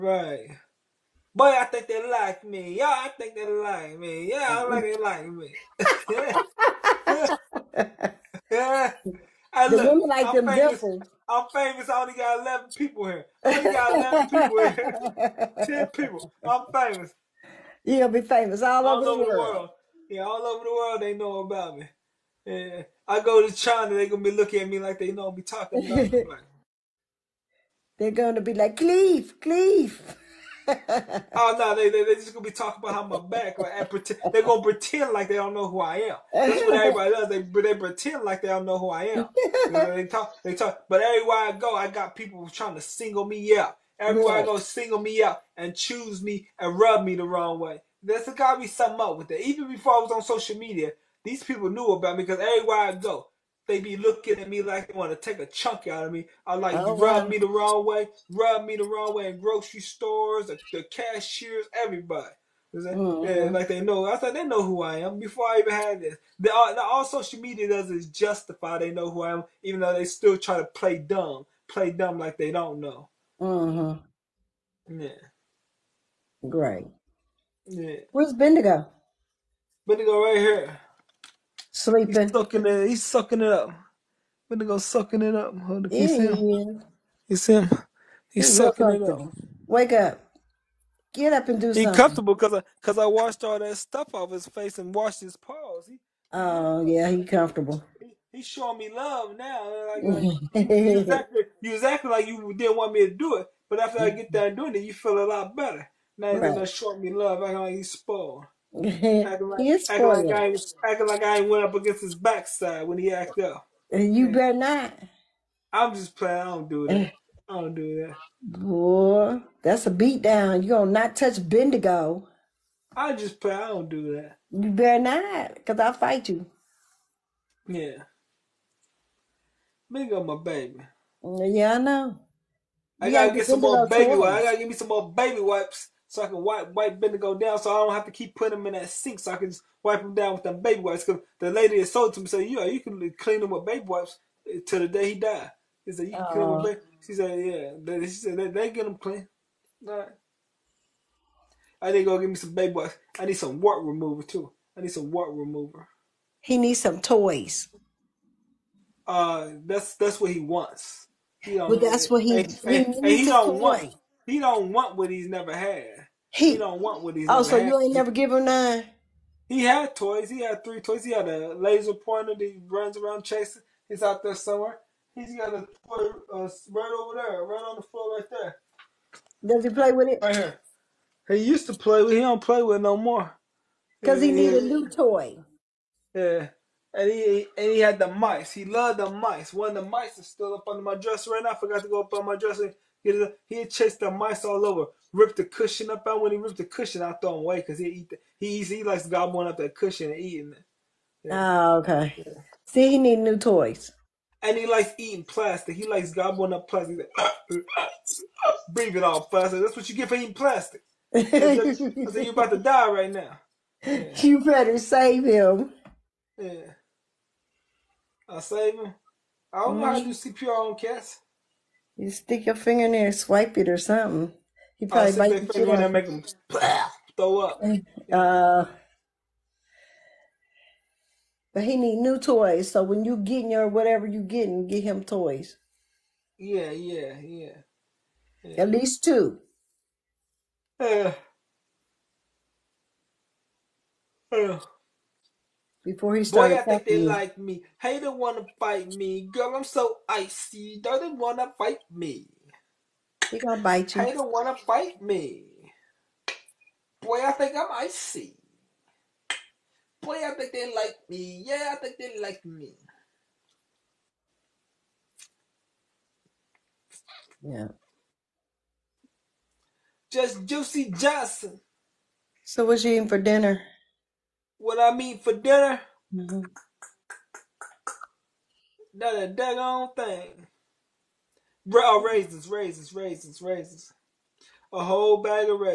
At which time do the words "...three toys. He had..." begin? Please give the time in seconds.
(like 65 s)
170 s.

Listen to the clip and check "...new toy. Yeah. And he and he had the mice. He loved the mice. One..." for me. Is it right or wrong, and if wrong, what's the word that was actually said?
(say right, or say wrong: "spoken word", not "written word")
right.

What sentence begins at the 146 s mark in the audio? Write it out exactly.
baby." She said, "Yeah." She said, "They, they get them clean." All right.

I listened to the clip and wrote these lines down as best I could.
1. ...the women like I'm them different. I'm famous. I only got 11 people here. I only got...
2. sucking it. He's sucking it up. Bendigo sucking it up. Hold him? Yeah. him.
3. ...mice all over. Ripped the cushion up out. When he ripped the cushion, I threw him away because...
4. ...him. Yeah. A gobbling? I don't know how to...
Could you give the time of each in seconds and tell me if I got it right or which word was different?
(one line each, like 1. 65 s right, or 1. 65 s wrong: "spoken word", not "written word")
1. 9 s right
2. 82 s right
3. 194 s right
4. 215 s wrong: "saving", not "gobbling".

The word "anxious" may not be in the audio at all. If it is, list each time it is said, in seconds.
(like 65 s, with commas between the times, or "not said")
not said.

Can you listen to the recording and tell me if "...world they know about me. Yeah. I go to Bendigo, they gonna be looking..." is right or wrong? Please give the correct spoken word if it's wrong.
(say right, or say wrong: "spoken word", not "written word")
wrong: "China", not "Bendigo".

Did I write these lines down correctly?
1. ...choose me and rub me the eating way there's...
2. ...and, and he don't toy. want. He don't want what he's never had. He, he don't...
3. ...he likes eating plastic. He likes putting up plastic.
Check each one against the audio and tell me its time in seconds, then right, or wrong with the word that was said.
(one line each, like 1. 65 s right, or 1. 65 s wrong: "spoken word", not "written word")
1. 45 s wrong: "wrong", not "eating"
2. 162 s right
3. 204 s wrong: "gobbling", not "putting".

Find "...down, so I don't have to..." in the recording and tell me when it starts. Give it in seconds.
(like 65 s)
137 s.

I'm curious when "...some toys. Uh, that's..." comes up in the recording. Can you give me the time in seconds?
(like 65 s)
156 s.